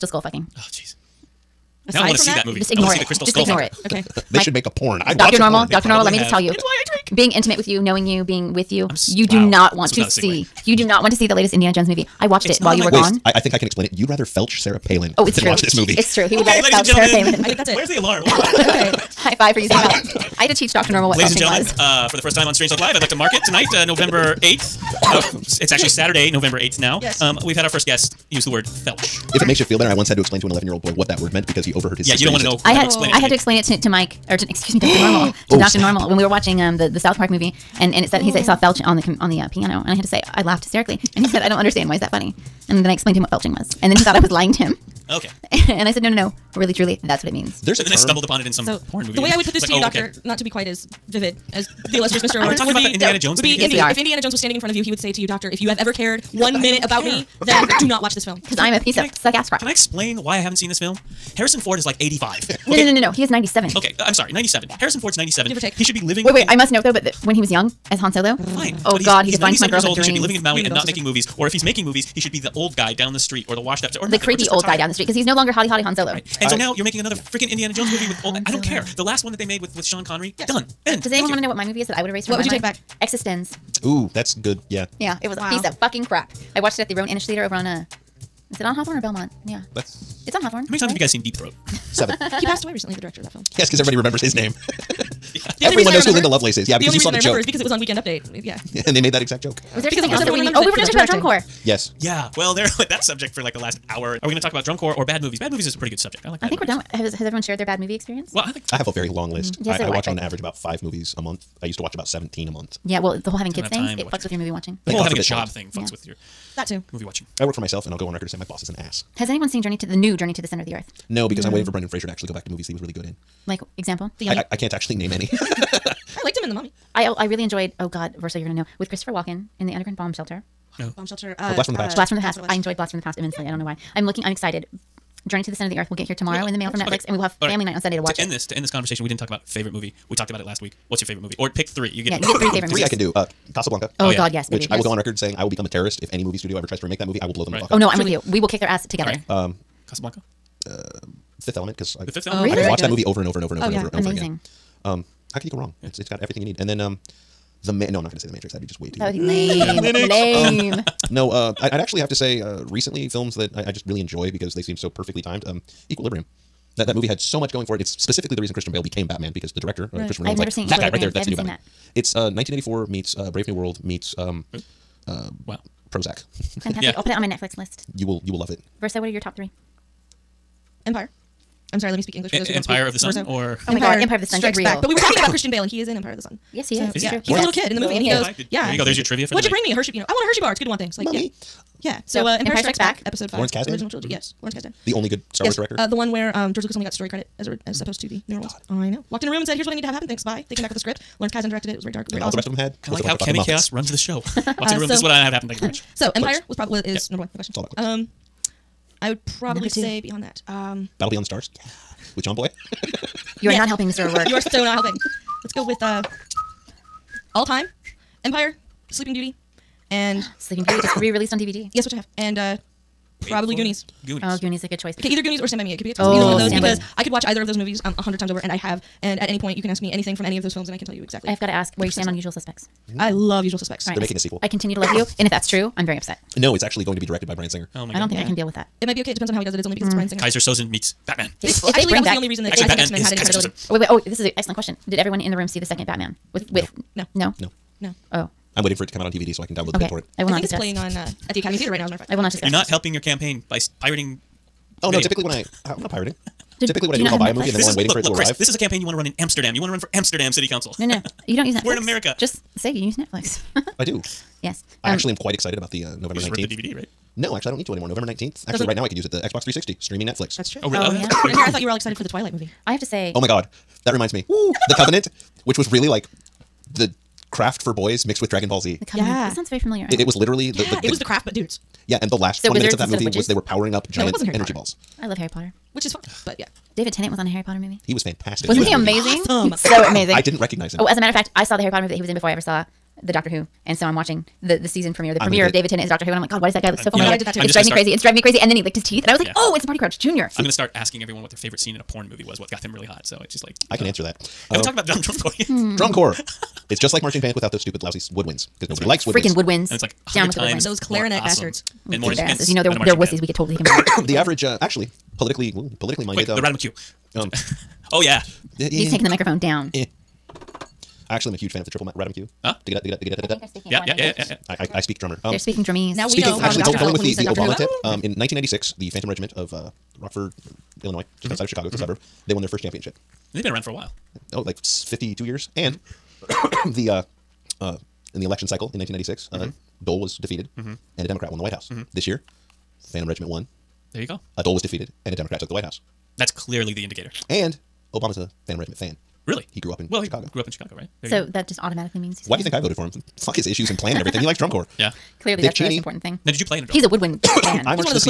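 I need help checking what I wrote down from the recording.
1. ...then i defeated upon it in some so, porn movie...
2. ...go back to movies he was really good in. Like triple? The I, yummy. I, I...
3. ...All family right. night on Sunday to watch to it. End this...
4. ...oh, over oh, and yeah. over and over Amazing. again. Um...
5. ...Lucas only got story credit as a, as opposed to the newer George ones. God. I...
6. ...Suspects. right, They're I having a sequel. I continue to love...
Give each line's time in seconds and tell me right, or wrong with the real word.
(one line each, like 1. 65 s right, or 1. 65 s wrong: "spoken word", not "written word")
1. 47 s wrong: "stumbled", not "defeated"
2. 122 s wrong: "example", not "triple"
3. 137 s right
4. 153 s right
5. 196 s wrong: "Thank", not "George"
6. 233 s wrong: "making", not "having".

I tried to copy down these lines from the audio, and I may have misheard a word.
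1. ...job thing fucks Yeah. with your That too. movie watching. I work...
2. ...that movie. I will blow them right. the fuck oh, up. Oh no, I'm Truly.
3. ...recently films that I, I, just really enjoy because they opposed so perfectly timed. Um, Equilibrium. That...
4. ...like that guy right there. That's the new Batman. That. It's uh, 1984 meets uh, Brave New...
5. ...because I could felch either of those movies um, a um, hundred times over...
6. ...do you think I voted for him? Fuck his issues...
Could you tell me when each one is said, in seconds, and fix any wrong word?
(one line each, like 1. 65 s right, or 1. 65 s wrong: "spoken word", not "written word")
1. 115 s right
2. 146 s right
3. 162 s wrong: "seemed", not "opposed"
4. 170 s right
5. 226 s wrong: "watch", not "felch"
6. 352 s right.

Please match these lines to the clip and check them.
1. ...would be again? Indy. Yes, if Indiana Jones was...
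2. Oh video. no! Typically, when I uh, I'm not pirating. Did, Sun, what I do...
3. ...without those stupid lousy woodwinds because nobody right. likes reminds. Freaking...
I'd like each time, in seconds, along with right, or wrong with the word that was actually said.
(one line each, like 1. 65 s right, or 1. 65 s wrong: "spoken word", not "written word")
1. 53 s right
2. 254 s wrong: "Typically", not "Sun"
3. 307 s wrong: "woodwinds", not "reminds".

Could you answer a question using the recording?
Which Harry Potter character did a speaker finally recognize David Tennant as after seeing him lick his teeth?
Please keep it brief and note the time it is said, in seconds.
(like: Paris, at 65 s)
Barty Crouch Junior, at 299 s.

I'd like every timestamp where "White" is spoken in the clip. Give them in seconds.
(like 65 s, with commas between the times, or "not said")
341 s, 345 s.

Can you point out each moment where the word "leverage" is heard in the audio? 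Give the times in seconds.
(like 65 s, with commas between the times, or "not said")
not said.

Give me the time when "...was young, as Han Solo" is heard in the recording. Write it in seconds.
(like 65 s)
67 s.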